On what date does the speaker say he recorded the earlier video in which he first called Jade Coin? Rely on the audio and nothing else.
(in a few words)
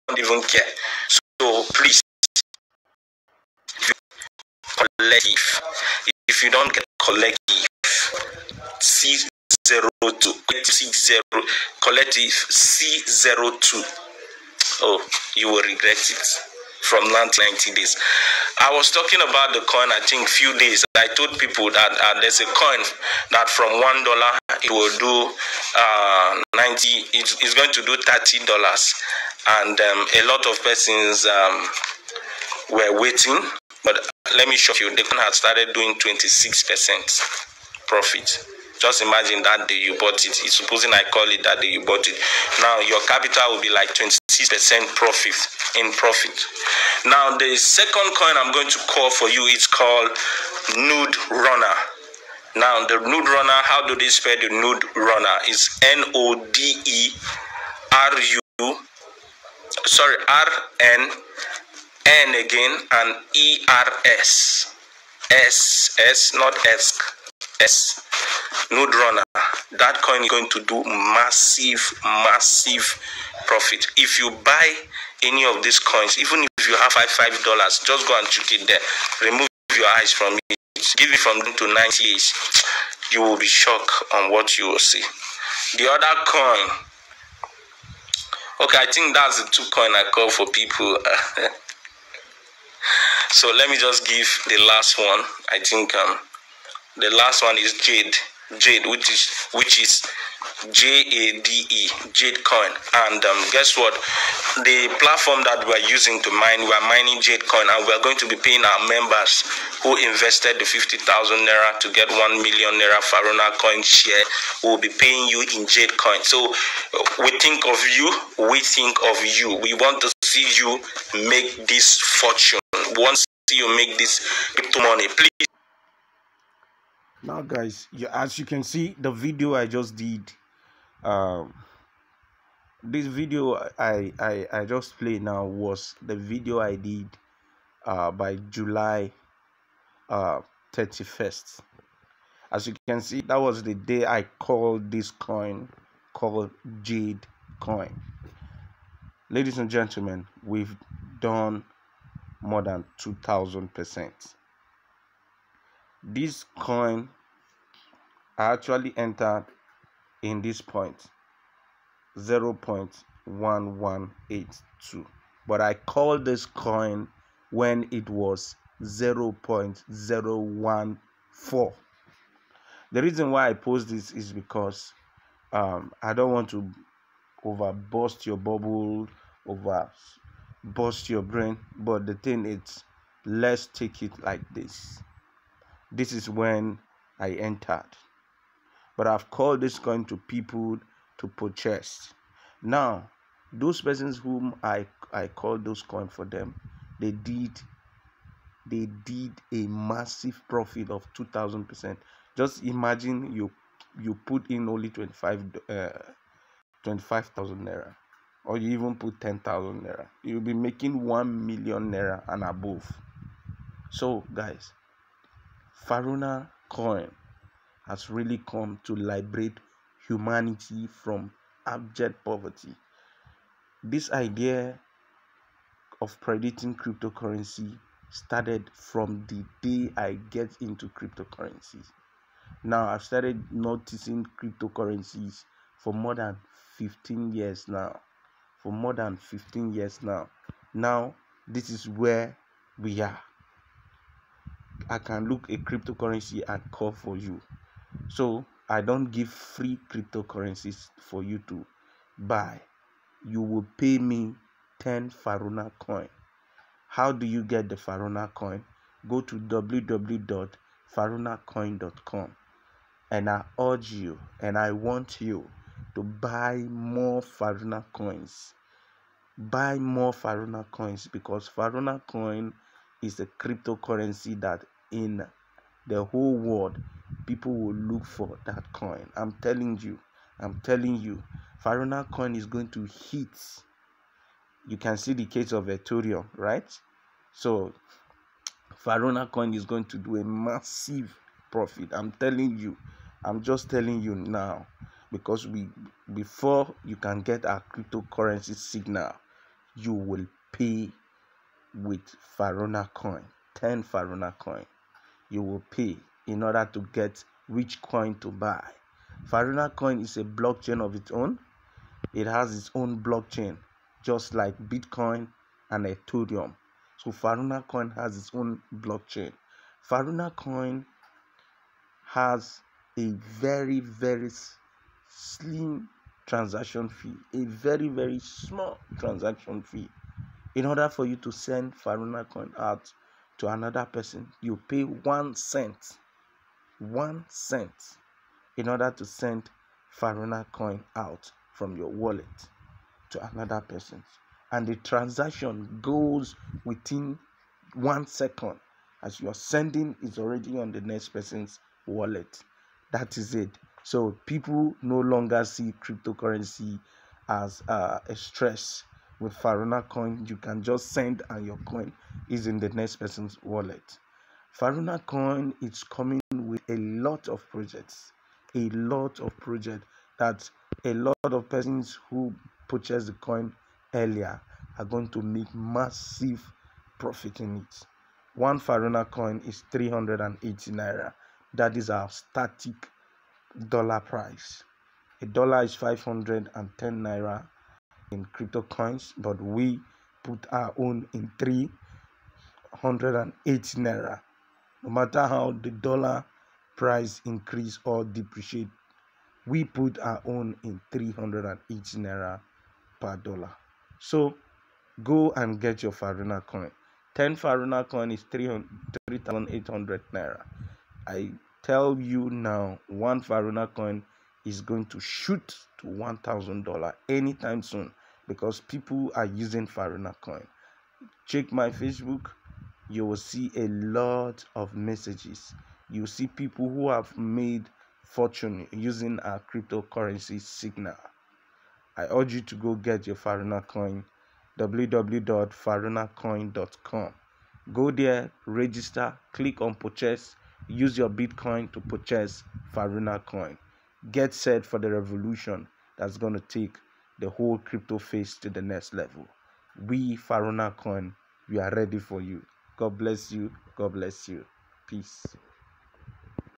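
July 31st.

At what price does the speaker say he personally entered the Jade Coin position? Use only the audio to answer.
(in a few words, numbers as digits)
0.1182.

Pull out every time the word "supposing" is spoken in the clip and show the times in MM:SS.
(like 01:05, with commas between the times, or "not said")
00:40.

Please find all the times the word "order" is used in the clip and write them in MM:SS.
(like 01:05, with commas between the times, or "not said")
05:06, 05:30, 05:38.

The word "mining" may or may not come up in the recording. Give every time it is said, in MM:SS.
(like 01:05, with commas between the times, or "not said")
01:46.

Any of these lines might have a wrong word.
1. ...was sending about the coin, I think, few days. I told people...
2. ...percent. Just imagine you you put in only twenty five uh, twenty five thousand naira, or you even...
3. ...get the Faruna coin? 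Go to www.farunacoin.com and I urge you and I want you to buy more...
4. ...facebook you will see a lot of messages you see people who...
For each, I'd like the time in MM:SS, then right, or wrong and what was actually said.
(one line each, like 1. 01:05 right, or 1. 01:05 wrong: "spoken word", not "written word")
1. 00:18 wrong: "talking", not "sending"
2. 03:21 right
3. 04:17 right
4. 07:01 right.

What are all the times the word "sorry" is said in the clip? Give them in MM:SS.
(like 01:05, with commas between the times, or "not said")
00:59.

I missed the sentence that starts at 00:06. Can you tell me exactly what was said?
If you don't get collective, C02, collective C0, collective C02.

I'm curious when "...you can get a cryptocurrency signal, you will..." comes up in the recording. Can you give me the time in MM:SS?
04:56.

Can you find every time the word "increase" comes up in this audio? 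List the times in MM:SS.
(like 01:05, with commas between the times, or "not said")
06:37.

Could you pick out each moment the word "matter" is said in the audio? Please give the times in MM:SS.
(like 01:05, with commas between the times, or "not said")
06:34.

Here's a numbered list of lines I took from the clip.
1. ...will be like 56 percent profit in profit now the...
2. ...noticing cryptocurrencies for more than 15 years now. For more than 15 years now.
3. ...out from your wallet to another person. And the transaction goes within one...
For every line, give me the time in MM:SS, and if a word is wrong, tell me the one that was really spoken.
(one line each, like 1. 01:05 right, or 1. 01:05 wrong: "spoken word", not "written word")
1. 00:43 wrong: "26", not "56"
2. 03:53 right
3. 05:40 right.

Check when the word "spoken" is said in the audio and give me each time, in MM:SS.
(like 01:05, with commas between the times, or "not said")
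not said.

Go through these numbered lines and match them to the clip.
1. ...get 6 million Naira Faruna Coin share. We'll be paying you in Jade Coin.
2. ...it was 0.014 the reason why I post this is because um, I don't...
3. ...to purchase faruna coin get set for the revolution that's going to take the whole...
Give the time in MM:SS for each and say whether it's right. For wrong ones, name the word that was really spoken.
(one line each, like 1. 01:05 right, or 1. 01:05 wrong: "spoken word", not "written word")
1. 01:51 wrong: "1", not "6"
2. 02:47 right
3. 07:21 right.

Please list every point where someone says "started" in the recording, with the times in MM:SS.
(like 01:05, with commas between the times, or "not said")
00:35, 03:48, 03:53.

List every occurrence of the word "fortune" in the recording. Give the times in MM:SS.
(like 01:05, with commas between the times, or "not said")
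02:02, 07:08.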